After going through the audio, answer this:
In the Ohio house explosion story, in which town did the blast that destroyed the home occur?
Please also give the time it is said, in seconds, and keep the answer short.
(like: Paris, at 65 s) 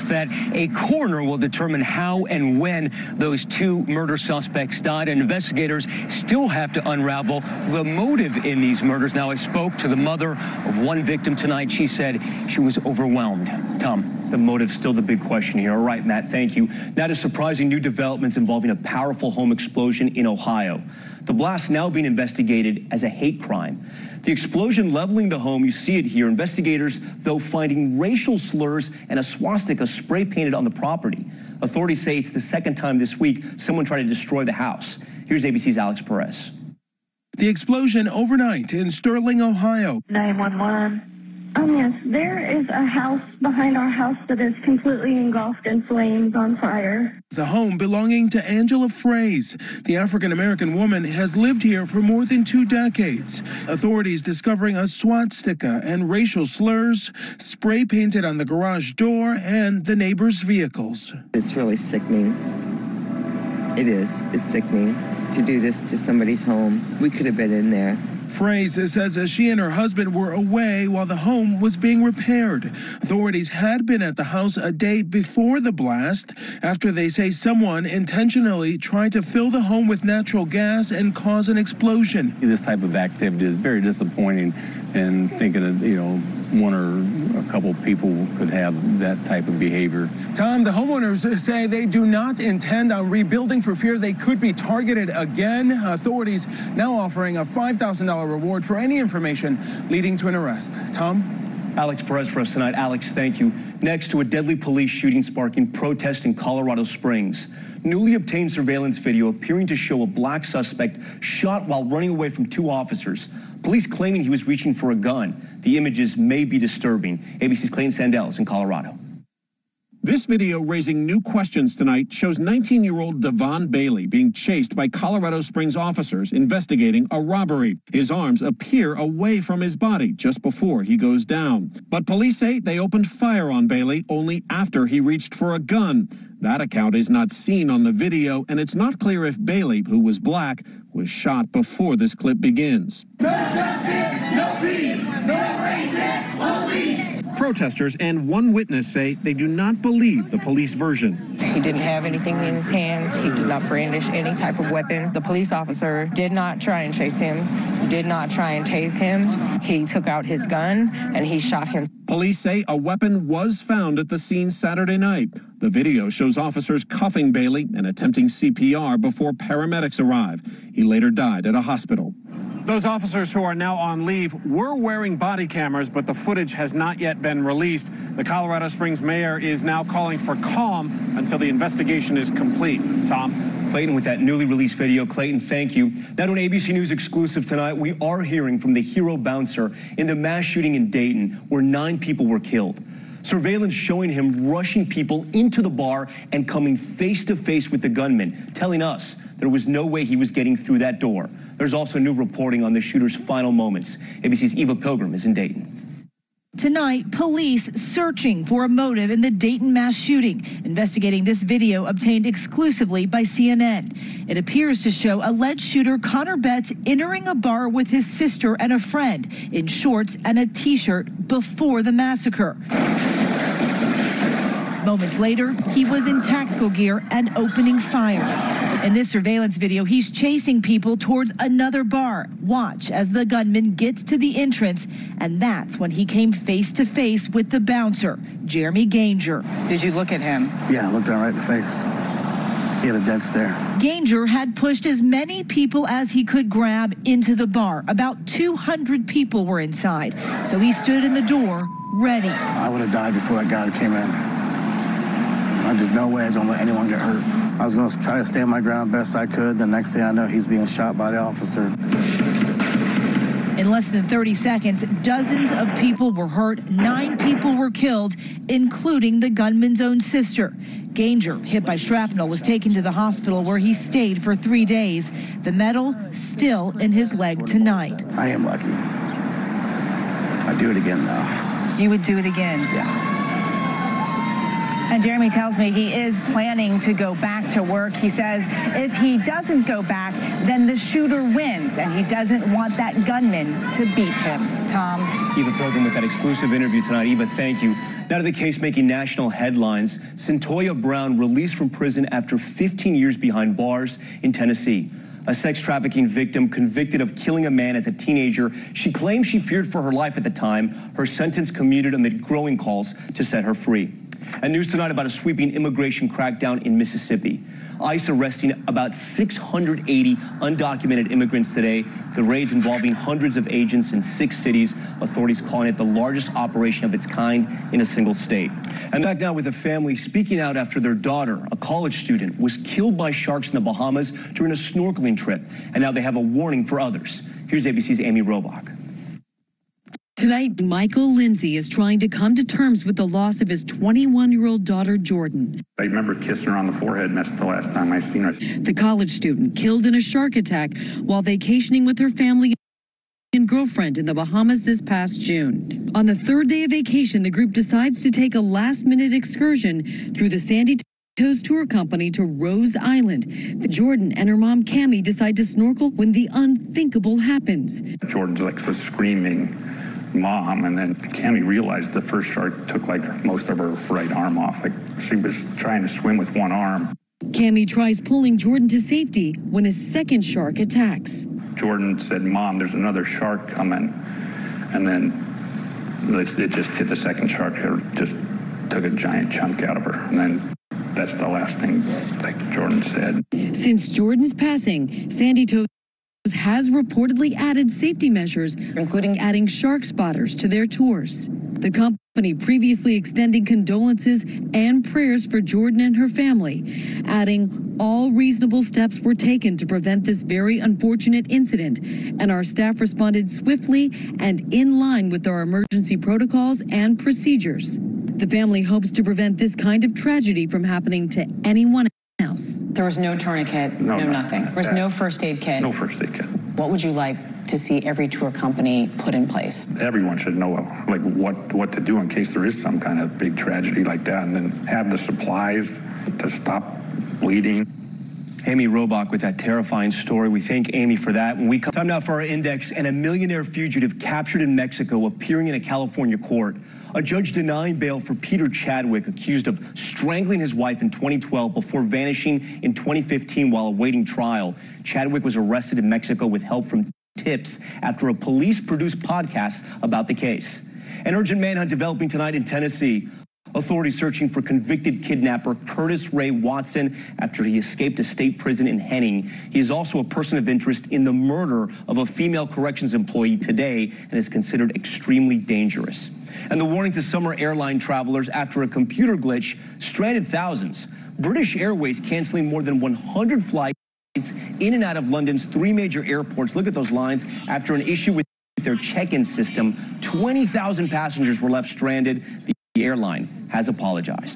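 Sterling, Ohio, at 38 s.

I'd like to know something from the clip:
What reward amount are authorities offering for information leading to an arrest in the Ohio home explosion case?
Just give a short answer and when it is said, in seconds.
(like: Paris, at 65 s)
$5,000, at 97 s.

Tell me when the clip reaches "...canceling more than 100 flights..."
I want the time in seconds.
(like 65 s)
481 s.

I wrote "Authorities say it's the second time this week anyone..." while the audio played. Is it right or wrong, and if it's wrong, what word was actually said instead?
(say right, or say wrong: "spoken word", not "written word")
wrong: "someone", not "anyone".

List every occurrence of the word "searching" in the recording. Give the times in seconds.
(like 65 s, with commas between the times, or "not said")
207 s, 463 s.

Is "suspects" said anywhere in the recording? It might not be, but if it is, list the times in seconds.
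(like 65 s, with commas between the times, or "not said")
4 s, 110 s.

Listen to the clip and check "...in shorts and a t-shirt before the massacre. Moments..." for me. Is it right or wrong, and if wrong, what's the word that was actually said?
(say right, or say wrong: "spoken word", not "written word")
right.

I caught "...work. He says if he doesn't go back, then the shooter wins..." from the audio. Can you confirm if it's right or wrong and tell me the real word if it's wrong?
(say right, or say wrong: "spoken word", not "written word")
right.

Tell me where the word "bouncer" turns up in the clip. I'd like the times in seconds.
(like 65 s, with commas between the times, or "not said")
189 s, 237 s.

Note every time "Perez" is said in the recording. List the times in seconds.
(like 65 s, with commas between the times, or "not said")
36 s, 102 s.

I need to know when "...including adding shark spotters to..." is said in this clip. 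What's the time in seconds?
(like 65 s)
398 s.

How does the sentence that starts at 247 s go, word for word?
About 200 people were inside, so he stood in the door ready.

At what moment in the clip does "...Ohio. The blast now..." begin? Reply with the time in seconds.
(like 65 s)
20 s.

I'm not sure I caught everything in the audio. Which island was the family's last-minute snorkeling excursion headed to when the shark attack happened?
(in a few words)
Rose Island.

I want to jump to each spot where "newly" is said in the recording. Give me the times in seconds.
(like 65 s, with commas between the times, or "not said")
107 s, 184 s.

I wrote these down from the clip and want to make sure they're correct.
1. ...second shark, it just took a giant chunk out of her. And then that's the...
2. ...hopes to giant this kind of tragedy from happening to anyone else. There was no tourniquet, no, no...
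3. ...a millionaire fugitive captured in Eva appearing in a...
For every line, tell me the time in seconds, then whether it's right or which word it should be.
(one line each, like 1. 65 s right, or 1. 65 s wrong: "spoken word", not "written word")
1. 386 s right
2. 418 s wrong: "prevent", not "giant"
3. 442 s wrong: "Mexico", not "Eva".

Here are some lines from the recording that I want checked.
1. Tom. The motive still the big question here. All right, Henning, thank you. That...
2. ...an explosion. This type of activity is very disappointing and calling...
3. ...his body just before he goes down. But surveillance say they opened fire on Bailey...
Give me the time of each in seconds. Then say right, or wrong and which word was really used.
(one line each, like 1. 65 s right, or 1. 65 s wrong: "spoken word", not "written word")
1. 13 s wrong: "Matt", not "Henning"
2. 81 s wrong: "thinking", not "calling"
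3. 129 s wrong: "police", not "surveillance".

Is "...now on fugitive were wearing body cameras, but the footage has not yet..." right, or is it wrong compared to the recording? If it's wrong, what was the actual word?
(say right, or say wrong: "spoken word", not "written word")
wrong: "leave", not "fugitive".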